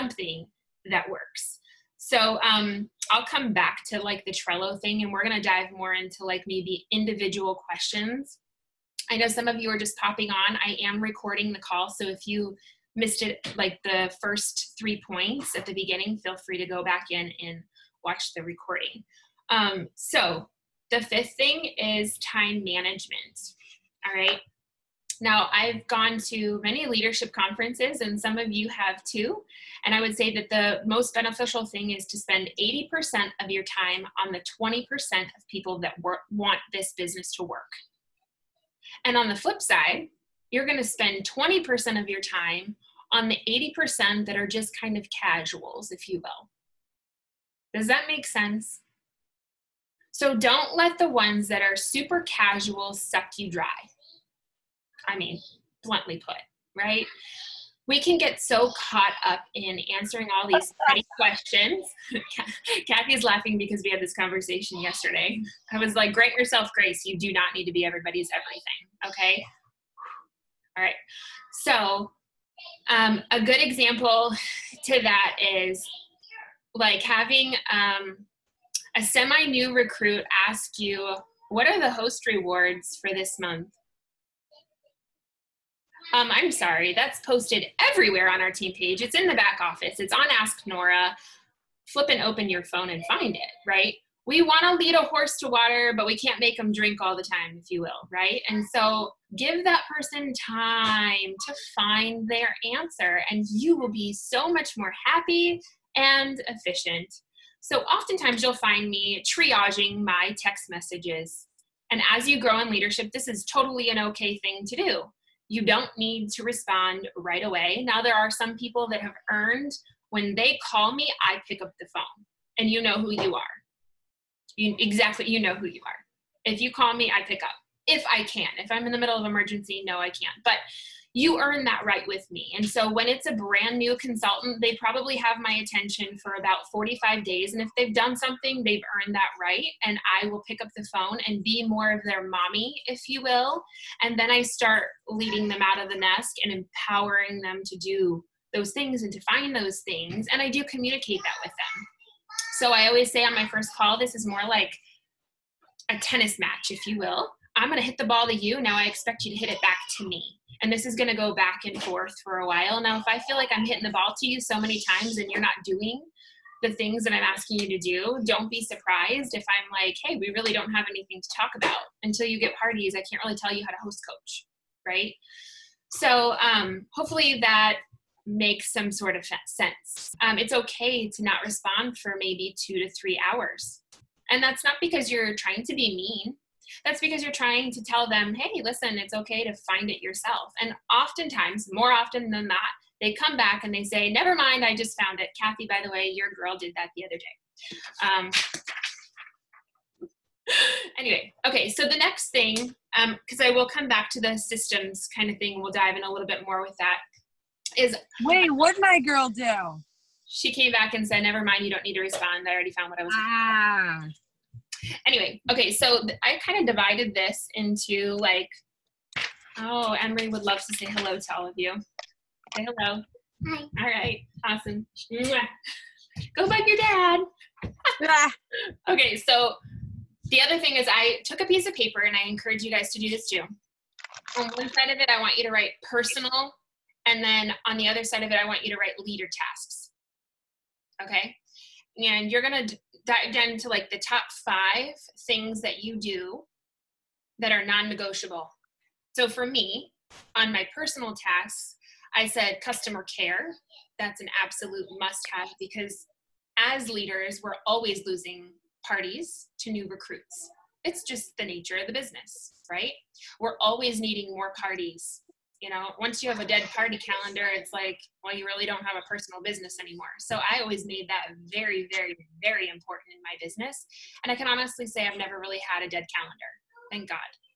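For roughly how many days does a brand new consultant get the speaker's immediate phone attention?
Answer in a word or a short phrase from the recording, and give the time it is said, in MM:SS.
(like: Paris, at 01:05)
45 days, at 02:16.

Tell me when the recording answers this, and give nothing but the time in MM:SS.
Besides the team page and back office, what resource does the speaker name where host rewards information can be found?
01:30.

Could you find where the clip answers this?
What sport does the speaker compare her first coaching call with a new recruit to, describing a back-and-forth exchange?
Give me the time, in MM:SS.
02:35.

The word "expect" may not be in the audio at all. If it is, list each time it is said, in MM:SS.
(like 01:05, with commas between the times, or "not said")
02:38.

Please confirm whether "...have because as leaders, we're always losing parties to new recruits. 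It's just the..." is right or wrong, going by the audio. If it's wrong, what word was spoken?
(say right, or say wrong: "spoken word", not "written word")
right.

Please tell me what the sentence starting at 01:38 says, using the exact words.
And so give that person time to find their answer, and you will be so much more happy and efficient.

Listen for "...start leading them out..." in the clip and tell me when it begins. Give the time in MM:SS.
02:24.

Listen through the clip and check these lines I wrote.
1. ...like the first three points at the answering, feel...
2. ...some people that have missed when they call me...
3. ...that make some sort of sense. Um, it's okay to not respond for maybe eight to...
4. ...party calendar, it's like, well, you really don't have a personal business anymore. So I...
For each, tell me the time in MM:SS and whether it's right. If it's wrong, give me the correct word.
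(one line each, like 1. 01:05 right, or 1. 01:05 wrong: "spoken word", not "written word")
1. 00:13 wrong: "beginning", not "answering"
2. 01:58 wrong: "earned", not "missed"
3. 02:57 wrong: "two", not "eight"
4. 04:26 right.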